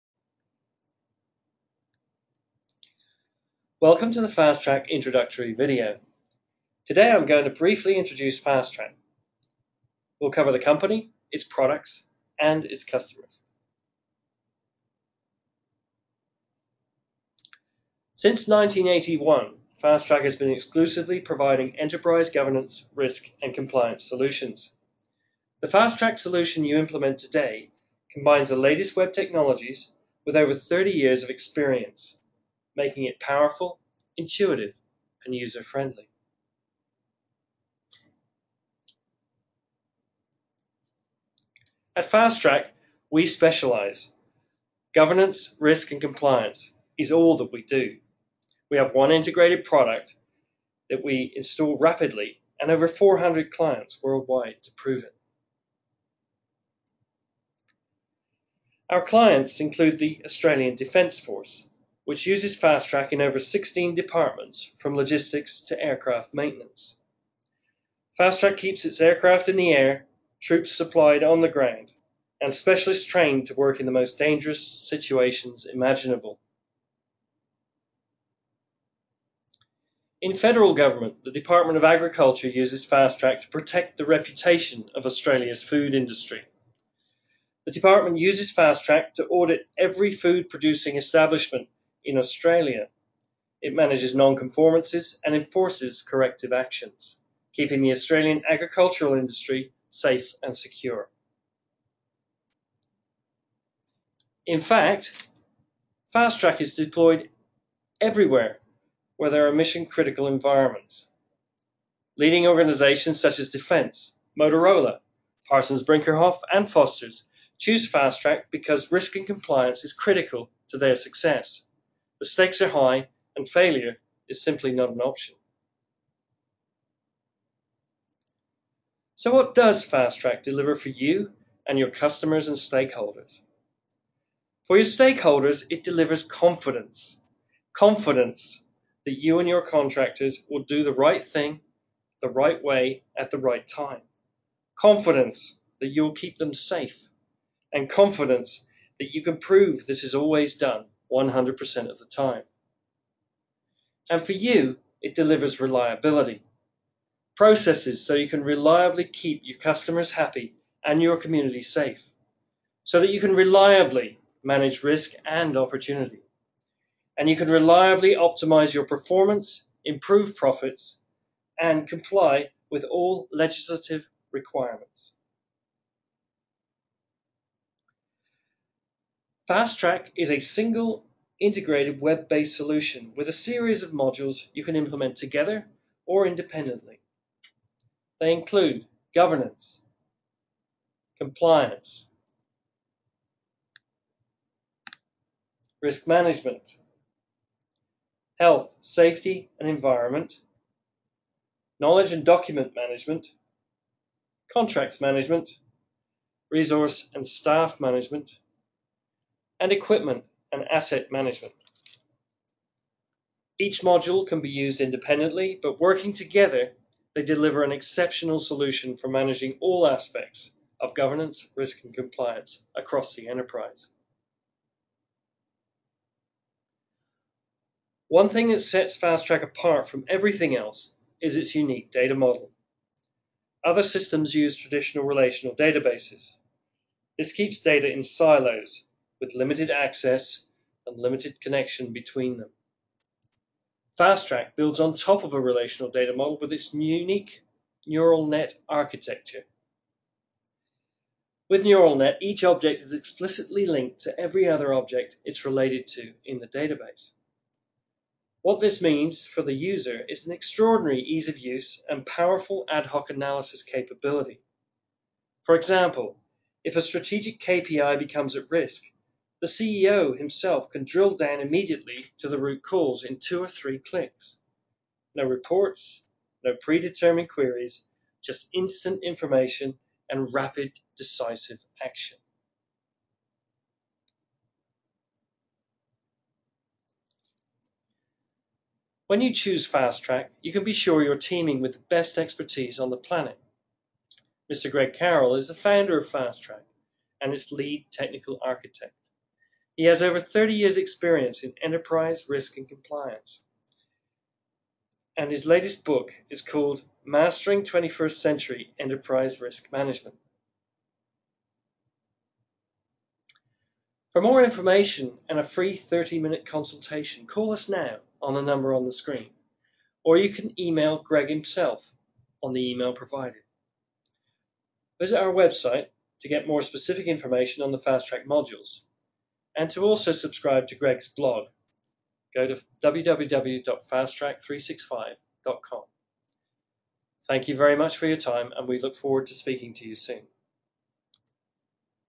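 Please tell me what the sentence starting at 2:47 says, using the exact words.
And you can reliably optimize your performance, improve profits, and comply with all legislative requirements.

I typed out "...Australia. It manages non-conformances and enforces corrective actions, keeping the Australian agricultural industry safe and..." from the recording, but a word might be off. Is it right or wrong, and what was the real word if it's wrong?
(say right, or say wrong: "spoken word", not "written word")
right.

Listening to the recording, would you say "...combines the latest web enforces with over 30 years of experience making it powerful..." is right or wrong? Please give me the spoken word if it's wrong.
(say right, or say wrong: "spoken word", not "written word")
wrong: "technologies", not "enforces".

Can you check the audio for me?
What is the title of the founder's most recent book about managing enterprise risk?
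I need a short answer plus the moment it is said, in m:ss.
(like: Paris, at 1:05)
Mastering 21st Century Enterprise Risk Management, at 5:07.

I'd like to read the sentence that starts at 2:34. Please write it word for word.
And for you, it delivers reliability.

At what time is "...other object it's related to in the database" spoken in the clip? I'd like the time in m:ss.
4:14.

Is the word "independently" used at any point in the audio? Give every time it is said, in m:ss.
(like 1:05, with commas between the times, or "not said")
3:06, 3:34.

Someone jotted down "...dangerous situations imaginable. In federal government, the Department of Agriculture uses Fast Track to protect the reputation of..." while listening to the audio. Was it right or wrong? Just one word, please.
right.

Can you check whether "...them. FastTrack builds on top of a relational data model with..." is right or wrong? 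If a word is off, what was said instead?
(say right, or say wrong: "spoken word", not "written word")
right.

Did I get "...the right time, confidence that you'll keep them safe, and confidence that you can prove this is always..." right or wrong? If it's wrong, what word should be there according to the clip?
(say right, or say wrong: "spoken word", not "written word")
right.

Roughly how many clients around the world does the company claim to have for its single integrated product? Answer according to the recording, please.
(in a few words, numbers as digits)
400.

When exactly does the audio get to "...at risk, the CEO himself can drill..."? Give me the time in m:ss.
4:28.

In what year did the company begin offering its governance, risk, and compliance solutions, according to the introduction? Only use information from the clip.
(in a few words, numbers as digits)
1981.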